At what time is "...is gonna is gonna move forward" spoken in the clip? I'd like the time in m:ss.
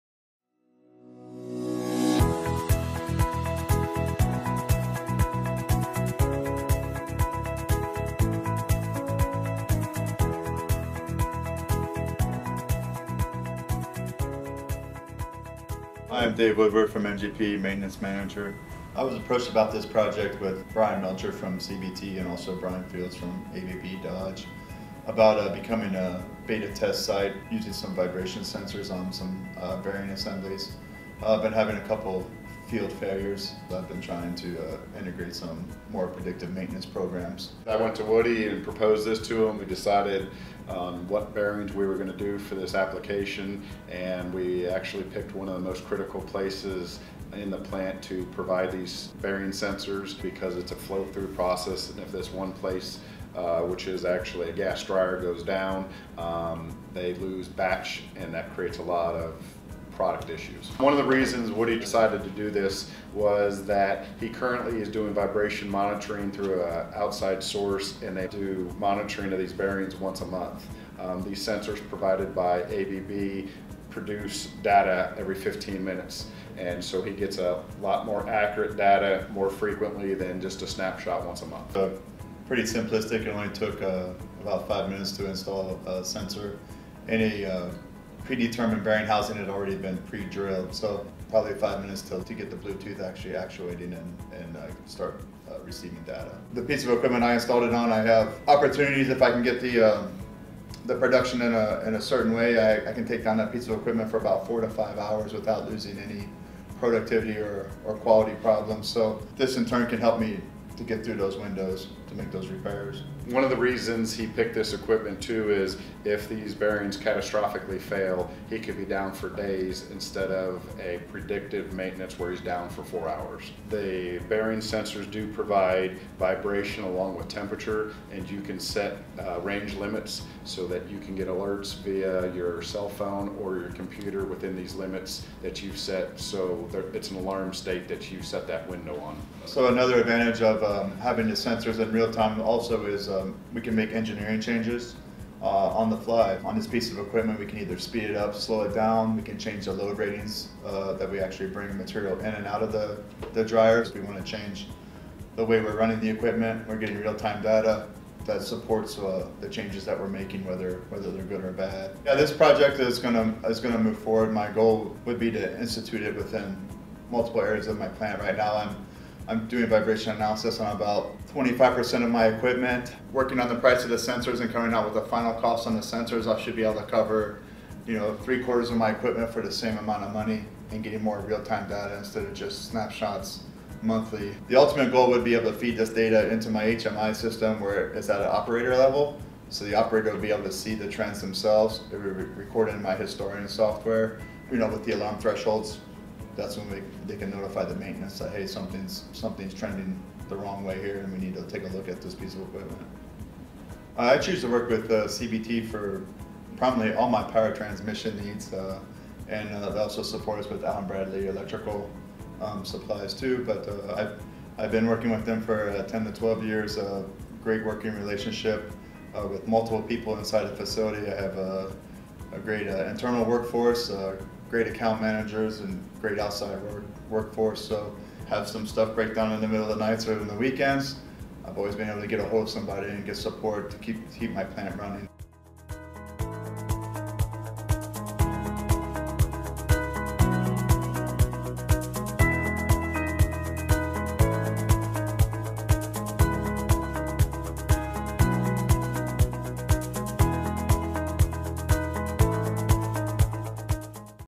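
2:42.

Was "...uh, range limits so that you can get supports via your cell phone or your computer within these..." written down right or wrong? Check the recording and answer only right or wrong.
wrong.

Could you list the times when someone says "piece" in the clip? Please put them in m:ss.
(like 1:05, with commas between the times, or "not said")
1:36, 1:43, 2:26, 3:22.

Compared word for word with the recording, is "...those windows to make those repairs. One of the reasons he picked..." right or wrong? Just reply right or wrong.
right.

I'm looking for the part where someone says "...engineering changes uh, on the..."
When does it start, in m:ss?
2:23.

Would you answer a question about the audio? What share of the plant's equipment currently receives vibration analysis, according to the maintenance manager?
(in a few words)
25%.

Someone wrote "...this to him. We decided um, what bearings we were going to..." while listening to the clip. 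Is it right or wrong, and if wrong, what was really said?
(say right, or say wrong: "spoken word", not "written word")
right.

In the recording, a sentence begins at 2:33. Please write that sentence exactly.
We want to change the way we're running the equipment.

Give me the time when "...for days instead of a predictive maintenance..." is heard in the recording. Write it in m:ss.
1:59.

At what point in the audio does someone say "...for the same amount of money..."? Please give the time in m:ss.
2:59.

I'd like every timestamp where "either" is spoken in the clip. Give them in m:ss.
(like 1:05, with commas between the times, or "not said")
2:27.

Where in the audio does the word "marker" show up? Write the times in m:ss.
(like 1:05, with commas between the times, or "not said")
not said.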